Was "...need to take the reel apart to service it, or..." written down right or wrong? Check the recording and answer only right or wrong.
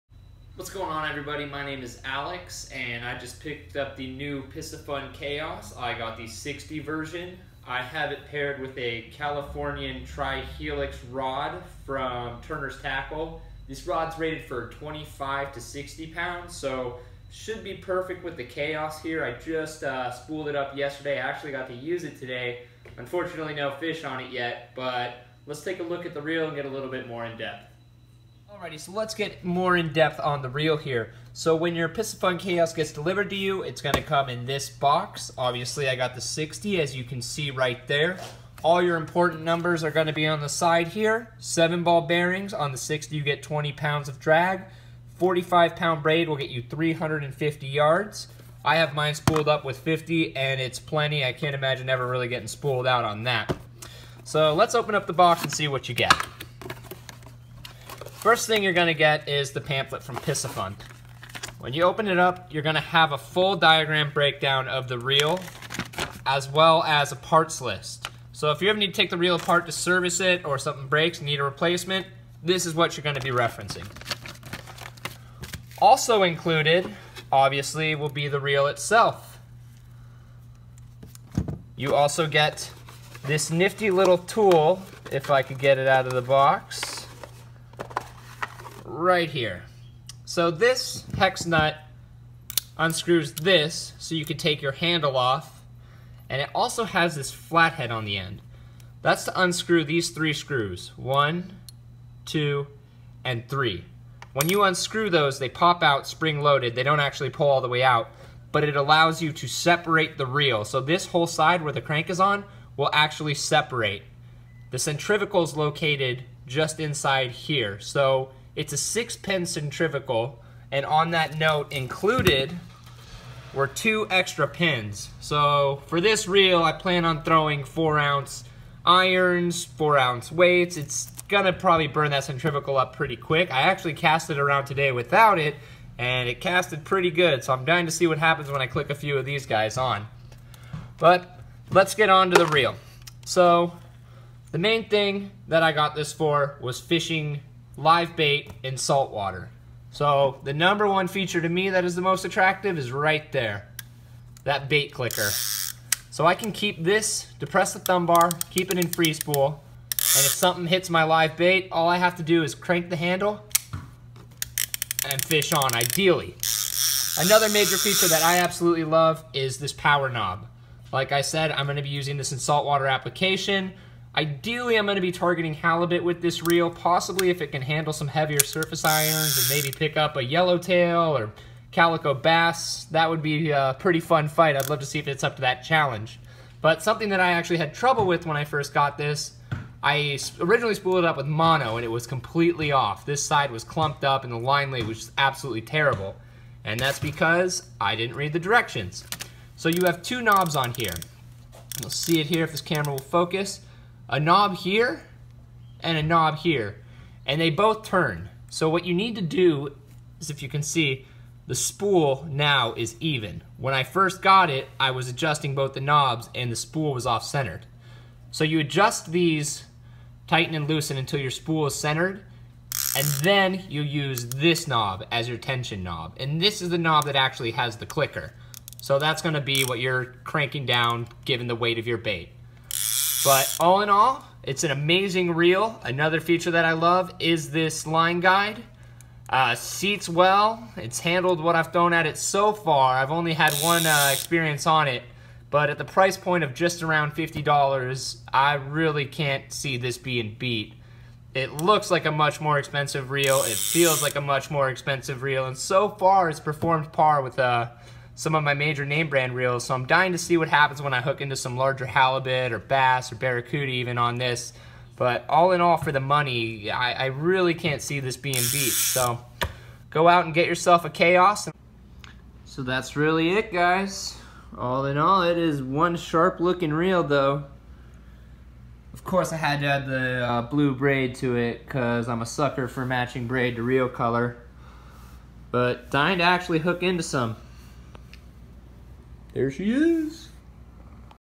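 right.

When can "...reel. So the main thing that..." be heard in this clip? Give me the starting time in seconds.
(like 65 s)
142 s.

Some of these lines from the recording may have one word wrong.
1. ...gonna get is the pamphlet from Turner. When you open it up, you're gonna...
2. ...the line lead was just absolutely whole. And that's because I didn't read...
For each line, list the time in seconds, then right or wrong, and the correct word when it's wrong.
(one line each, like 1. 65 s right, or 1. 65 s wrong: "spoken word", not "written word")
1. 58 s wrong: "Piscifun", not "Turner"
2. 194 s wrong: "terrible", not "whole".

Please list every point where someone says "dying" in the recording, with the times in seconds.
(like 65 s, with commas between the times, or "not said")
137 s, 259 s, 285 s.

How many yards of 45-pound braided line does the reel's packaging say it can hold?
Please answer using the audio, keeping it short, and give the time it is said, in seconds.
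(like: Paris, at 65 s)
350, at 46 s.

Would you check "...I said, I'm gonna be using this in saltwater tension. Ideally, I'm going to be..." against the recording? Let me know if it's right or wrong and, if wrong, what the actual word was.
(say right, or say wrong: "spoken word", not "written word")
wrong: "application", not "tension".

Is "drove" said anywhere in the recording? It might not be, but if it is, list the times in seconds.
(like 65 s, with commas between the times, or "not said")
not said.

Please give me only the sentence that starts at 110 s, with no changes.
So this whole side where the crank is on will actually separate.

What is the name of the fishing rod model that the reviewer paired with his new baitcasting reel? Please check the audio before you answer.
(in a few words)
Californian Tri-Helix.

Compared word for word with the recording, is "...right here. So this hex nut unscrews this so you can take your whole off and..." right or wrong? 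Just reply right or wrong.
wrong.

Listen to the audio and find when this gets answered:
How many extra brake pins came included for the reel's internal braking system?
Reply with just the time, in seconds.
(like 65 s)
123 s.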